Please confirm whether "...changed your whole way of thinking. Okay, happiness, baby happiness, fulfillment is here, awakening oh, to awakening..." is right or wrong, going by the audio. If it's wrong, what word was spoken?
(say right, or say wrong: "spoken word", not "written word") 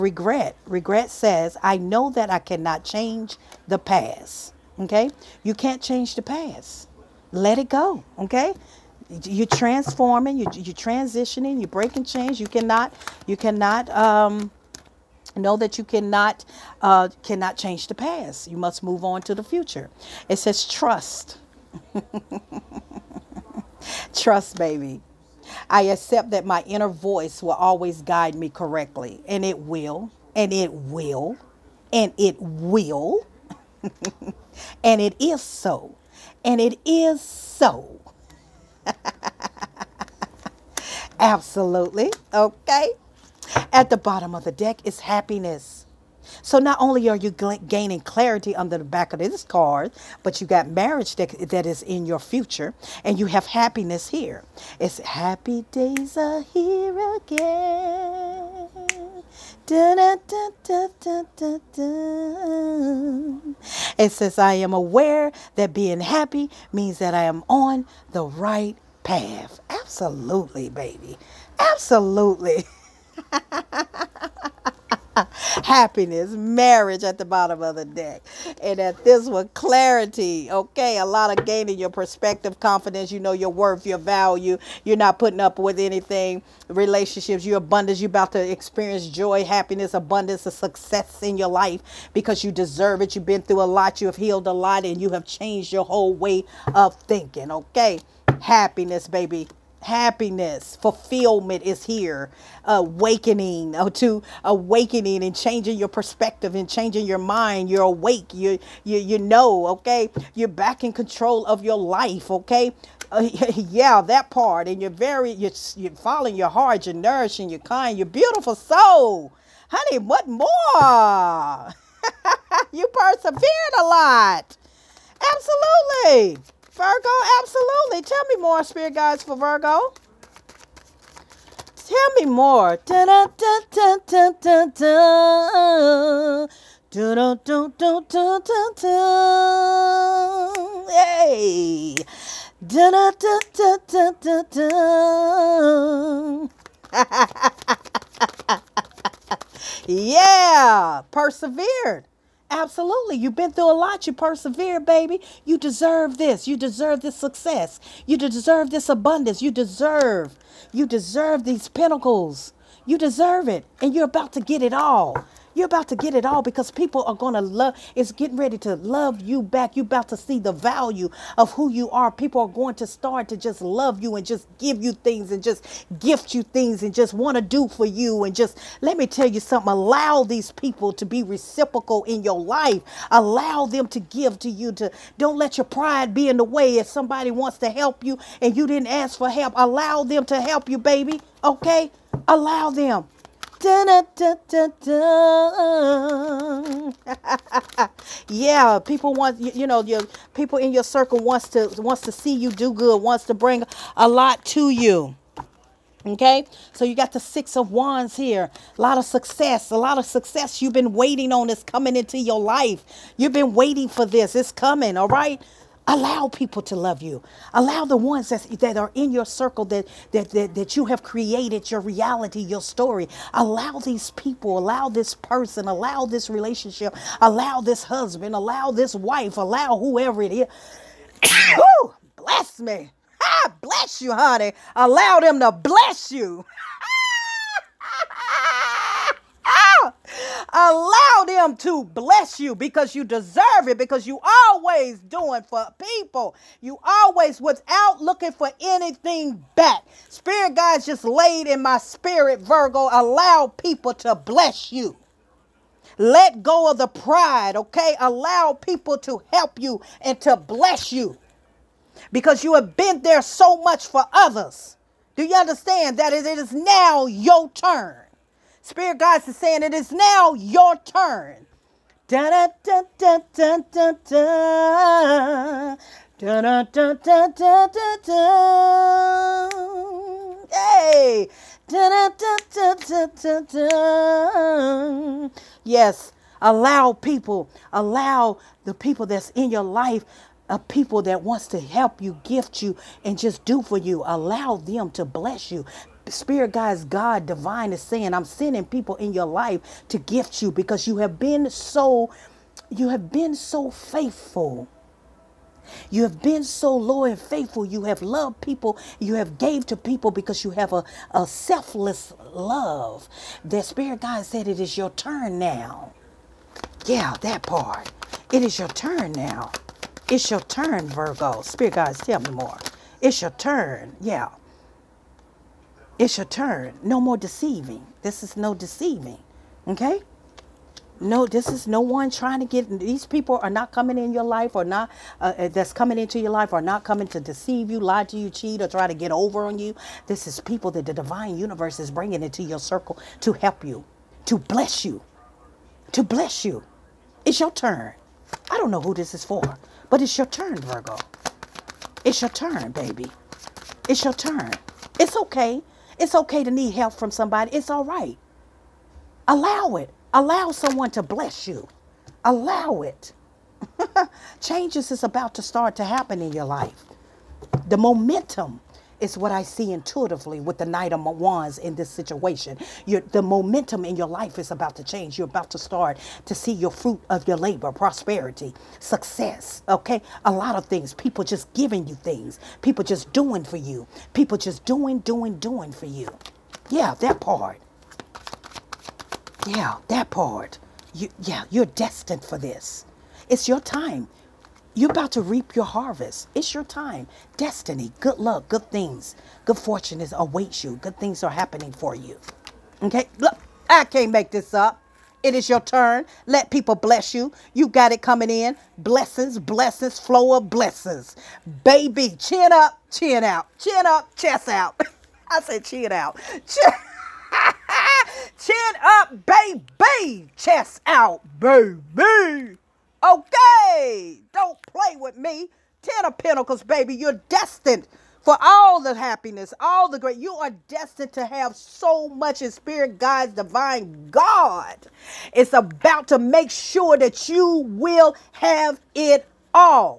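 right.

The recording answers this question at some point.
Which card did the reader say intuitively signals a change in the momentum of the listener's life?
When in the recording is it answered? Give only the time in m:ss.
6:10.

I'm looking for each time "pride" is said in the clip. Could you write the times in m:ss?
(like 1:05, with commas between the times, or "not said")
3:05, 4:16.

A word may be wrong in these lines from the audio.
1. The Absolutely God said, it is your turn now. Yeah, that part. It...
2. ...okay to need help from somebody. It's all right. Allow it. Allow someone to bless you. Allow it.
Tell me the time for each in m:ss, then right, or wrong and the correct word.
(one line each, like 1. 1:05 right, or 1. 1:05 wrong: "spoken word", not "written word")
1. 5:13 wrong: "Spirit", not "Absolutely"
2. 5:56 right.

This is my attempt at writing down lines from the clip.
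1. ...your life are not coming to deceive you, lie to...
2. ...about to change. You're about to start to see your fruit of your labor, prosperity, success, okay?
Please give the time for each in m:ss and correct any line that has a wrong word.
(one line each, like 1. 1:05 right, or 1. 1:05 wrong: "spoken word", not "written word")
1. 5:36 right
2. 6:14 right.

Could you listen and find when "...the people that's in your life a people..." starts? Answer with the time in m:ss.
4:48.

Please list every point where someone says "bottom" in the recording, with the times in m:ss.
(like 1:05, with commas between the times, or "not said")
0:43, 1:17.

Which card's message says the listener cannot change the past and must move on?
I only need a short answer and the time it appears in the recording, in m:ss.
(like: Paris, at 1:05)
Regret, at 0:00.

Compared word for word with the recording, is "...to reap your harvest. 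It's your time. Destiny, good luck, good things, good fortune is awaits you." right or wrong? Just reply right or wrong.
right.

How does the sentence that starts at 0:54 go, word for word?
It's happy days are here again.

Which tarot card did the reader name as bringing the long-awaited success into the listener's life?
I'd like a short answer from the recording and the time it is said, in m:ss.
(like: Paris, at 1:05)
Six of Wands, at 3:27.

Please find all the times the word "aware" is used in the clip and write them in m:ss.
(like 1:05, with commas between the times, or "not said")
1:04.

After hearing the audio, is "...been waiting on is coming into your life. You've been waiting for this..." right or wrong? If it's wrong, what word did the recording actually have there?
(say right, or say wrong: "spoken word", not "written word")
right.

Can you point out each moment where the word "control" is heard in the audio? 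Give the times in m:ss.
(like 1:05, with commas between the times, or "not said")
1:50.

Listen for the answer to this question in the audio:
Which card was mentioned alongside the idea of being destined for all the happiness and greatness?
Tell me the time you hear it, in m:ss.
7:05.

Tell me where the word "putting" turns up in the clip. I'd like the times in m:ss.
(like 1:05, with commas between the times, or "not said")
1:25.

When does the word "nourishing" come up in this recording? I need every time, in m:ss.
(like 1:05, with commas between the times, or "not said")
1:56.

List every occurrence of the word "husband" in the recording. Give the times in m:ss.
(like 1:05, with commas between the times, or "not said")
3:47.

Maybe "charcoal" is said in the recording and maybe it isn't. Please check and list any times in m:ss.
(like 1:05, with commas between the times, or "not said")
not said.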